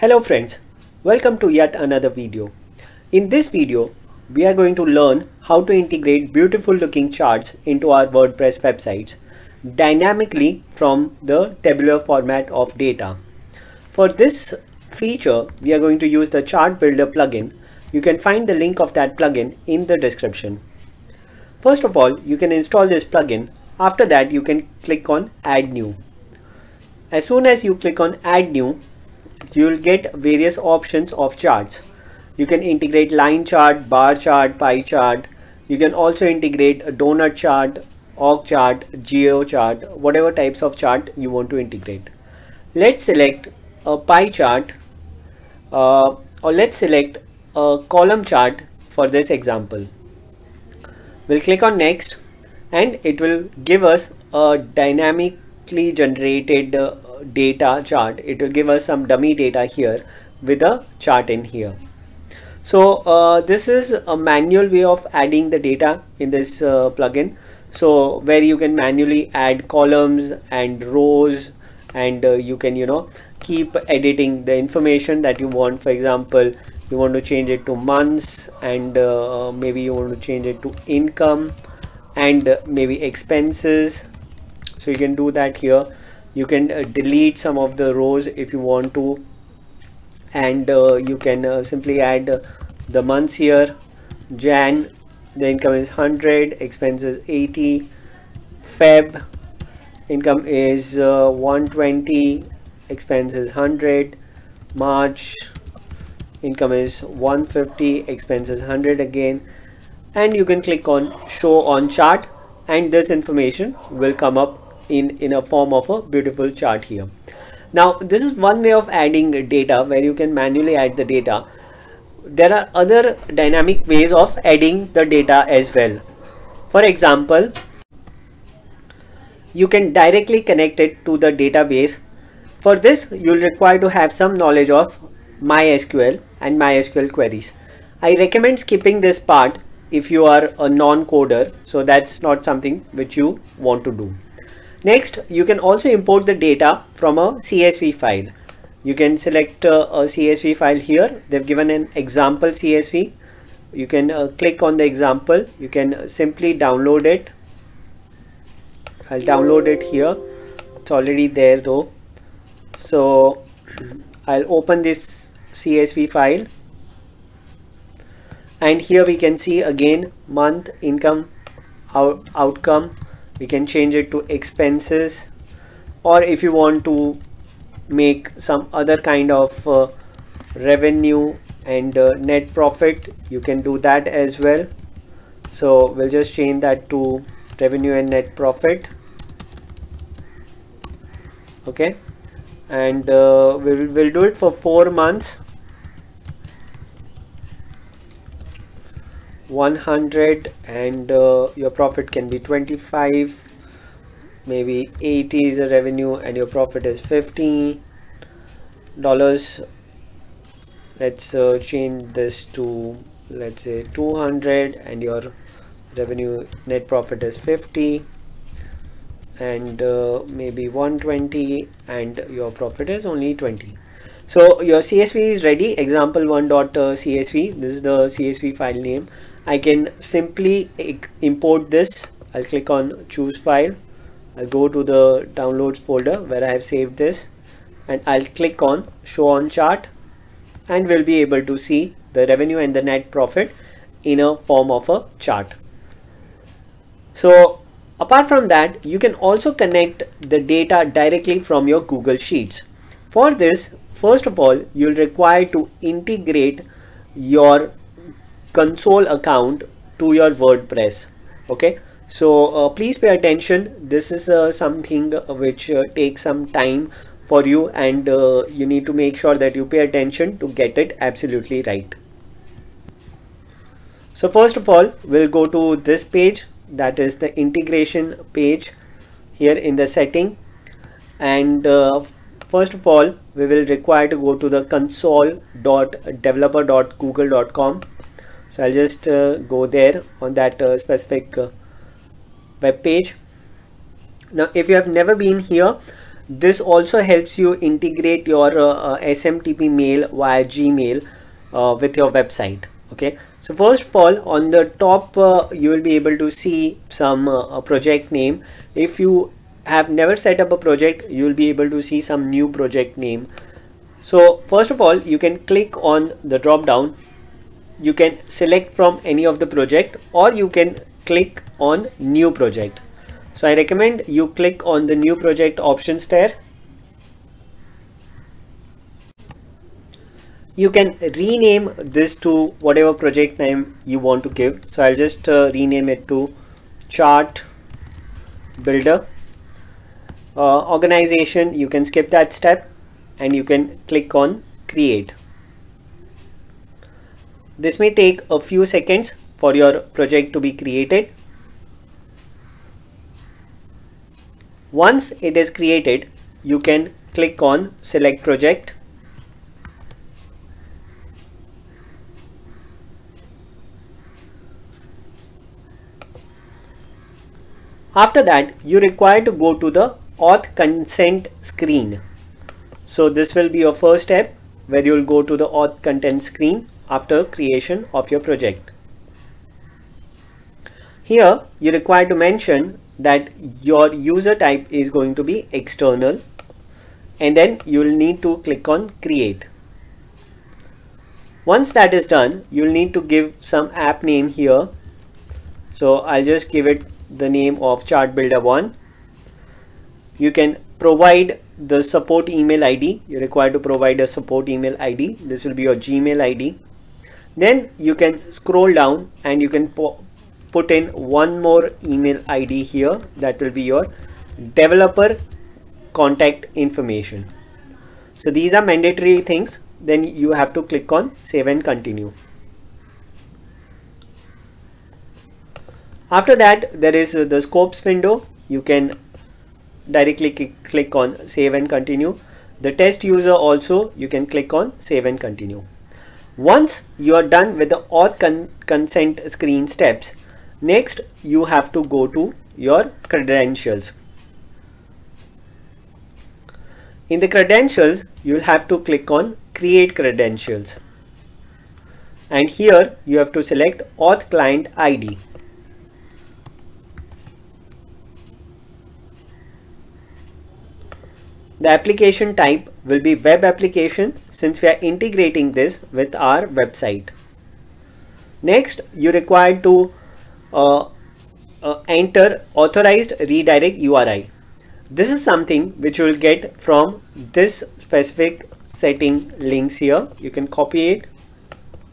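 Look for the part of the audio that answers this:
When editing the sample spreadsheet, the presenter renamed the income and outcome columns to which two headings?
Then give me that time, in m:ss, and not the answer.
3:07.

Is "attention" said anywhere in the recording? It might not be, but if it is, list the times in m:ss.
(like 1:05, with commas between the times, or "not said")
4:23, 4:29.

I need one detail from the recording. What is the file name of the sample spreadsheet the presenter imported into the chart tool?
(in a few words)
example1.csv.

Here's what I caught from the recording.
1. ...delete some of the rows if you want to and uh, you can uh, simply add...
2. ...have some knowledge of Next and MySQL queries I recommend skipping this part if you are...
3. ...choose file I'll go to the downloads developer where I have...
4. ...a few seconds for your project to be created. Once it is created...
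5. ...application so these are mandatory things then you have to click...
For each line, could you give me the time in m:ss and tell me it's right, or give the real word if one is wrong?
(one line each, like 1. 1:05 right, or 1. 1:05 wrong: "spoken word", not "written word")
1. 1:26 right
2. 2:13 wrong: "MySQL", not "Next"
3. 3:53 wrong: "folder", not "developer"
4. 5:48 right
5. 6:56 wrong: "information", not "application".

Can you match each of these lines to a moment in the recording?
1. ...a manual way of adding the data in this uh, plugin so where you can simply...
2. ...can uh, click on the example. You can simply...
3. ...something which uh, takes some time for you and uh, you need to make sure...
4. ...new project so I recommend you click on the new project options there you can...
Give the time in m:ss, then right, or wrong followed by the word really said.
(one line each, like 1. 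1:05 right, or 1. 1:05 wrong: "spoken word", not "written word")
1. 1:04 wrong: "manually", not "simply"
2. 2:33 right
3. 4:24 right
4. 5:21 right.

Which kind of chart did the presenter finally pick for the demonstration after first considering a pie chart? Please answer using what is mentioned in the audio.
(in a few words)
column chart.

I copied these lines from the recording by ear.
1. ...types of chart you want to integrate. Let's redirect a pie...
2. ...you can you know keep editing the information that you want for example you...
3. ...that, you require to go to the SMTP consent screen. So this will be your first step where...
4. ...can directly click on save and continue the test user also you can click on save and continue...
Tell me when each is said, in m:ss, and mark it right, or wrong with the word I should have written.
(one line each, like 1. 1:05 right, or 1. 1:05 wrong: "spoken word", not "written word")
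1. 0:40 wrong: "select", not "redirect"
2. 1:12 right
3. 6:08 wrong: "OAuth", not "SMTP"
4. 7:08 right.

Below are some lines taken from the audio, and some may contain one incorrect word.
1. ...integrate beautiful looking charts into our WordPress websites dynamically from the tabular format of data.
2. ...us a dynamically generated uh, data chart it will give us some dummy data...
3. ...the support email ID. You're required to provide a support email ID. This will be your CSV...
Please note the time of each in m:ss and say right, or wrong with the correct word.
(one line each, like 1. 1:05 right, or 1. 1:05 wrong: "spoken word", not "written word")
1. 0:05 right
2. 0:53 right
3. 6:41 wrong: "Gmail", not "CSV".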